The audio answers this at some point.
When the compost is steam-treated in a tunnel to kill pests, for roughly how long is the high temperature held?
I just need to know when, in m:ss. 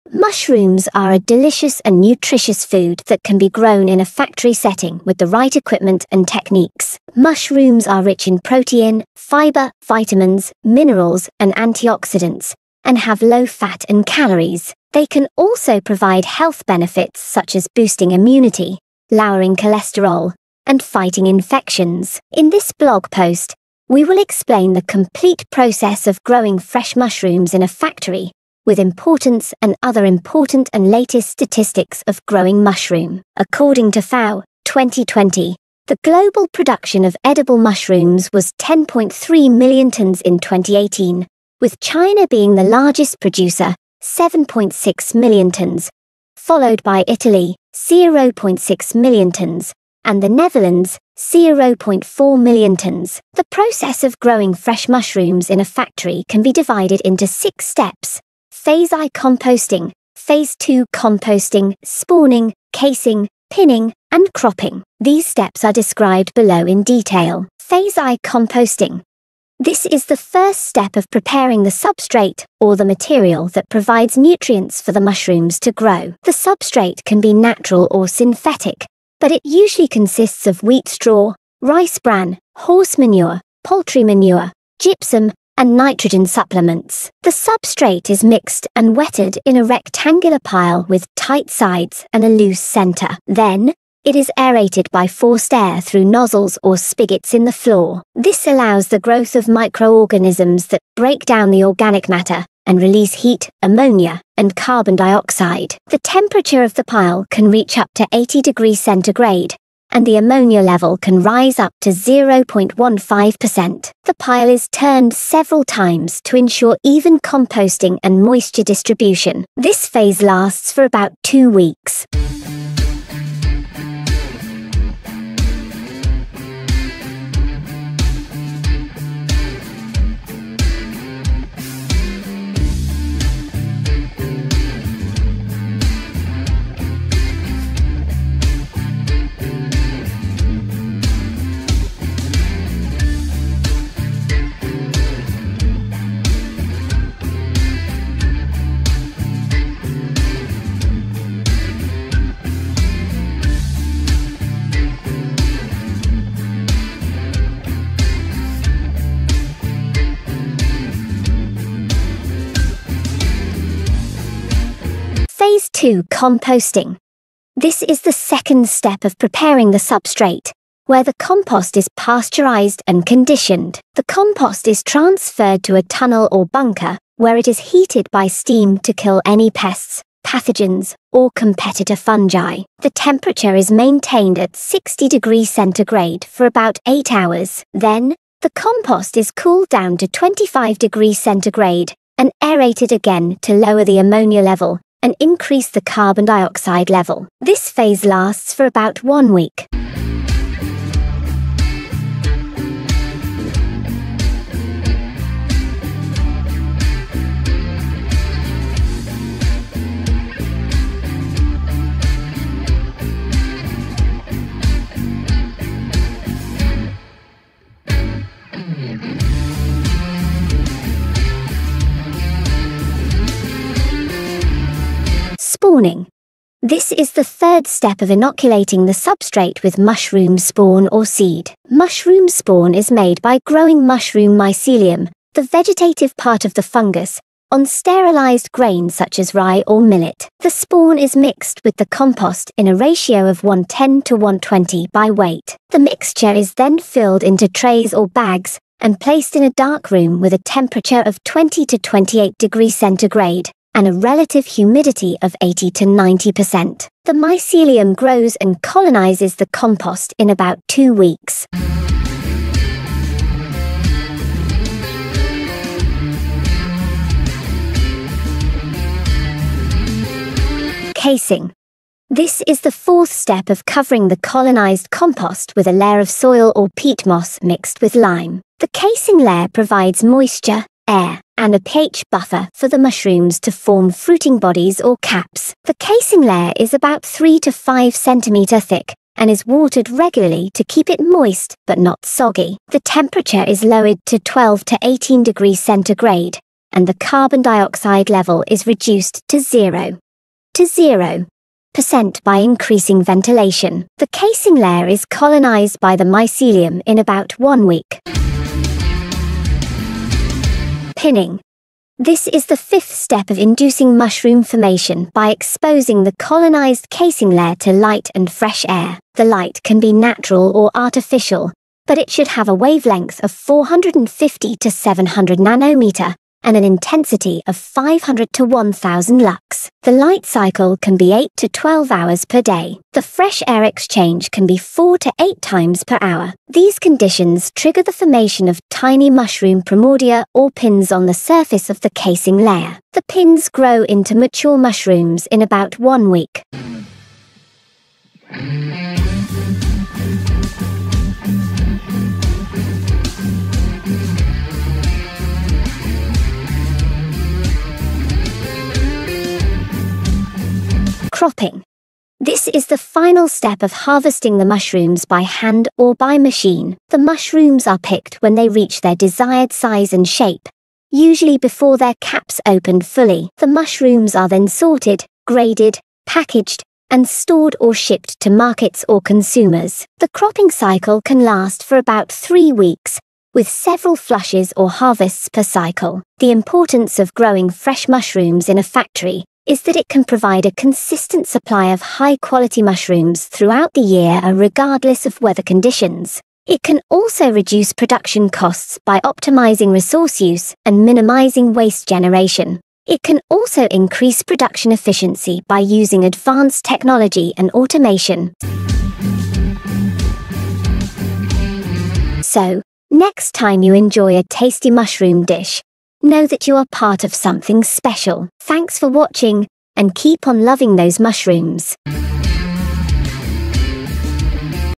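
3:06.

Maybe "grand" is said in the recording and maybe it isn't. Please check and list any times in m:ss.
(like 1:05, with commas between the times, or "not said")
not said.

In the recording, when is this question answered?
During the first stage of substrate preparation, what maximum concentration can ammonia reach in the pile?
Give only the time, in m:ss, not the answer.
1:51.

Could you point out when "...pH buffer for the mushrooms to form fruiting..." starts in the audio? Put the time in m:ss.
4:41.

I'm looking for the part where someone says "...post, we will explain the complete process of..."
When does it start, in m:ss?
0:23.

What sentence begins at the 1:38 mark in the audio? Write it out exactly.
This allows the growth of microorganisms that break down the organic matter and release heat, ammonia, and carbon dioxide.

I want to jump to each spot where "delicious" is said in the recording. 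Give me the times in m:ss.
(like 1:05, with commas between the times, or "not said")
0:01.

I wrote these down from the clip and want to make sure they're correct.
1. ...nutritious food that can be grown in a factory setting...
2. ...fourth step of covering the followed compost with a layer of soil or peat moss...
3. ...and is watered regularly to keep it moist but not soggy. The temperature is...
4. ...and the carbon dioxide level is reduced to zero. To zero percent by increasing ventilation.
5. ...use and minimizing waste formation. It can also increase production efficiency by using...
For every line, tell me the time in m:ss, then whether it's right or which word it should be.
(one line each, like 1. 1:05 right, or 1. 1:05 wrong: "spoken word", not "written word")
1. 0:01 right
2. 4:32 wrong: "colonized", not "followed"
3. 4:49 right
4. 4:56 right
5. 6:40 wrong: "generation", not "formation".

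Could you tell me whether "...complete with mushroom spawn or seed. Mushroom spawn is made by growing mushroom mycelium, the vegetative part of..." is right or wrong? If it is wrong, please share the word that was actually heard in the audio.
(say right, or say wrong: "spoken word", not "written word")
wrong: "substrate", not "complete".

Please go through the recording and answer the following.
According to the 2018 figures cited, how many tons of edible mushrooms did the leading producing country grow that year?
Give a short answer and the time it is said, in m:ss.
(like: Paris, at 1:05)
7.6 million tons, at 0:44.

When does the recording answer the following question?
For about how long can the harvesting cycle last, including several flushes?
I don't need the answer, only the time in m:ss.
6:22.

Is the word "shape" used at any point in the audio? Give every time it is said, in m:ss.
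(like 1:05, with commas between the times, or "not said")
6:10.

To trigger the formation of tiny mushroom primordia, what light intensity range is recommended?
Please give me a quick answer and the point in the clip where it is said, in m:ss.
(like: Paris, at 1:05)
500 to 1000 lux, at 5:27.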